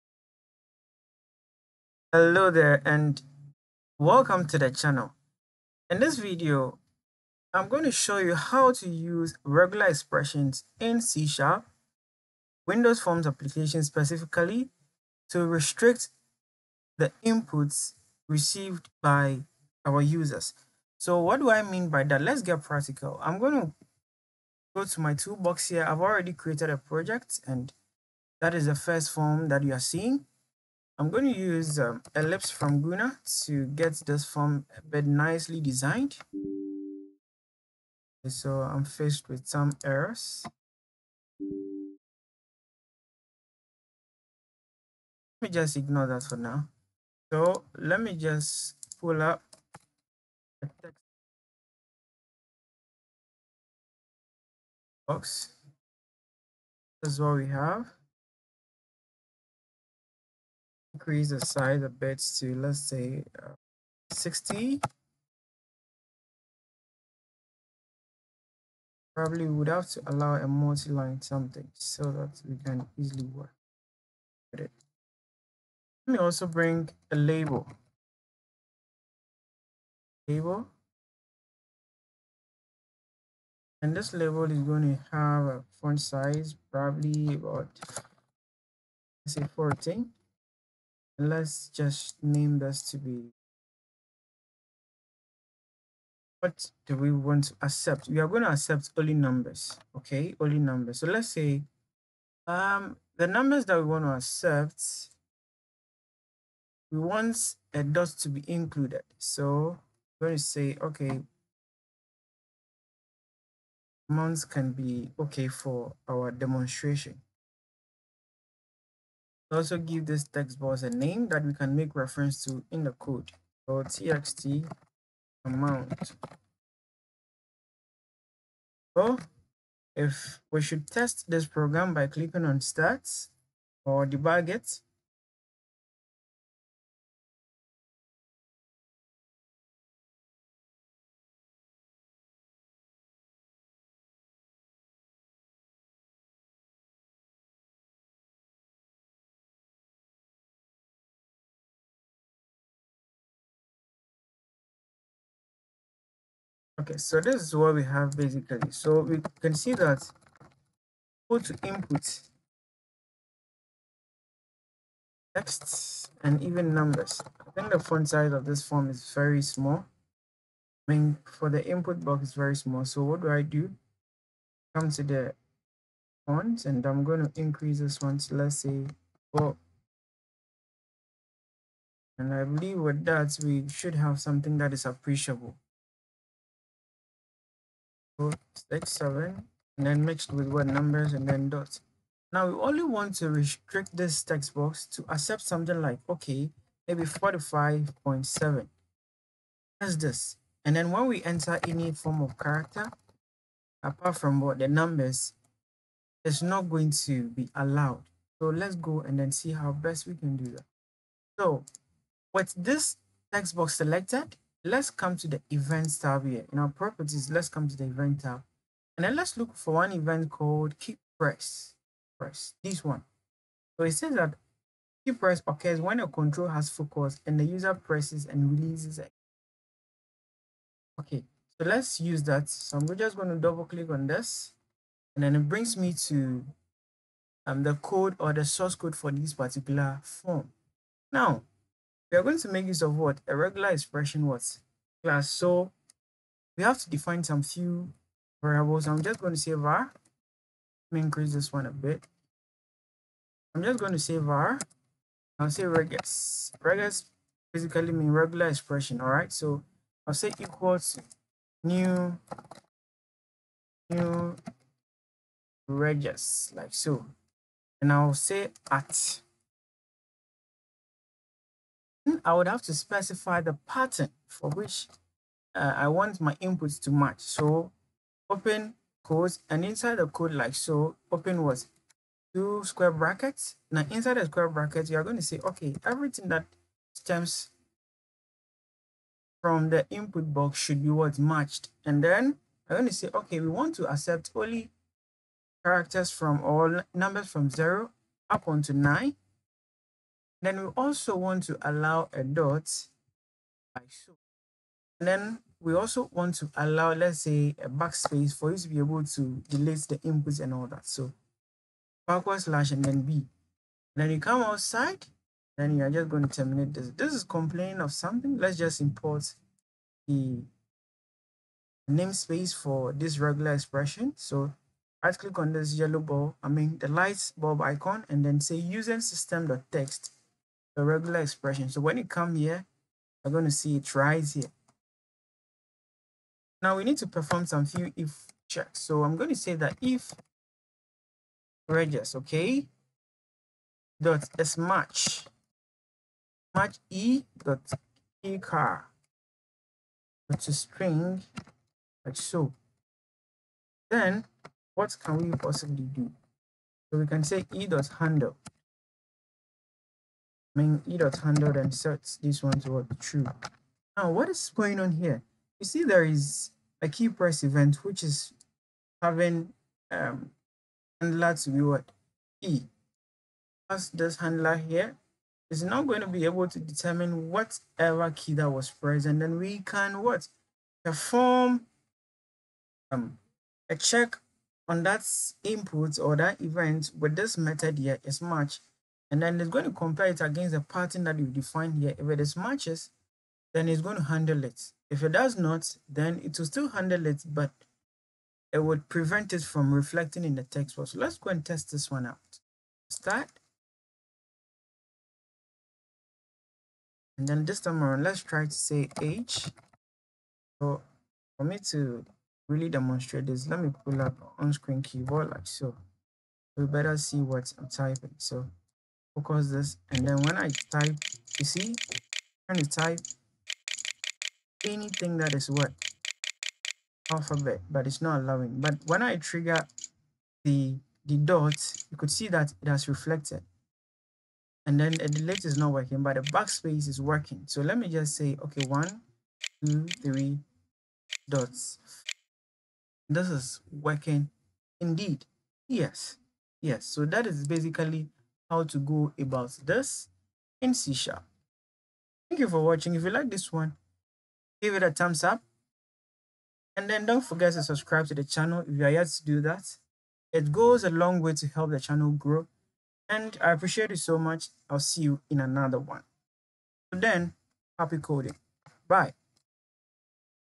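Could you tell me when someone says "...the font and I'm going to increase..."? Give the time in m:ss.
2:55.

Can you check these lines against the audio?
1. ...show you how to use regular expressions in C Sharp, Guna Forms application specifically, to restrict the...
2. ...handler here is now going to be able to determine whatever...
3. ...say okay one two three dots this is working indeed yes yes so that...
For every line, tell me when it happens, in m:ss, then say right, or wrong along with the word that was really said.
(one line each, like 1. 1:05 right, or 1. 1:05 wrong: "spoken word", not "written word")
1. 0:07 wrong: "Windows", not "Guna"
2. 6:14 right
3. 7:18 right.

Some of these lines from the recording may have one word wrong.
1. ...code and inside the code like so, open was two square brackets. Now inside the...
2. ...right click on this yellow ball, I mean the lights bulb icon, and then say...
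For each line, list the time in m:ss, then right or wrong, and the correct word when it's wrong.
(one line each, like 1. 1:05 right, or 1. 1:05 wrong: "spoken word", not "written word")
1. 4:39 right
2. 5:25 right.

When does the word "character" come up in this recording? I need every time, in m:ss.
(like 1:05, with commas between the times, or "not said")
3:22, 4:55.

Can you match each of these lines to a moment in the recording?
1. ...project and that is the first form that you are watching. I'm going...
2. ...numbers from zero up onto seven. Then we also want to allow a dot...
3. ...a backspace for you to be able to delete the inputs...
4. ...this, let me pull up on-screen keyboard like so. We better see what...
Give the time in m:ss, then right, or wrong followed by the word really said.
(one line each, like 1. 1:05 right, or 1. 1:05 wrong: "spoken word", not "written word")
1. 0:26 wrong: "seeing", not "watching"
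2. 4:56 wrong: "nine", not "seven"
3. 5:07 right
4. 6:53 right.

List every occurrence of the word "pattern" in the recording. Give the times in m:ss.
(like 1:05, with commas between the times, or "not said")
4:33, 6:30.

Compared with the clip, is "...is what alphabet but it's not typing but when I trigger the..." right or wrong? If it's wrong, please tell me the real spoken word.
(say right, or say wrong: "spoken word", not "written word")
wrong: "allowing", not "typing".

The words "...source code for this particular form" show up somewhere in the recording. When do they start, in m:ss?
3:58.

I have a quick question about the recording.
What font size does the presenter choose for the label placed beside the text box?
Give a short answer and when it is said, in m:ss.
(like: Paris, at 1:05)
14, at 1:29.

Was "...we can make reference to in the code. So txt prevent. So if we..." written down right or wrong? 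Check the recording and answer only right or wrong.
wrong.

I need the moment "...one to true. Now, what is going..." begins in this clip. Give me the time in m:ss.
6:02.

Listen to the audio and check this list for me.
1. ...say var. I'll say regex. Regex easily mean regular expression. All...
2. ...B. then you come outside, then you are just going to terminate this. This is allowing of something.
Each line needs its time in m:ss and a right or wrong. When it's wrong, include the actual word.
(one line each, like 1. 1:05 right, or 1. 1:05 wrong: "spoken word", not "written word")
1. 4:13 wrong: "basically", not "easily"
2. 5:13 wrong: "complaining", not "allowing".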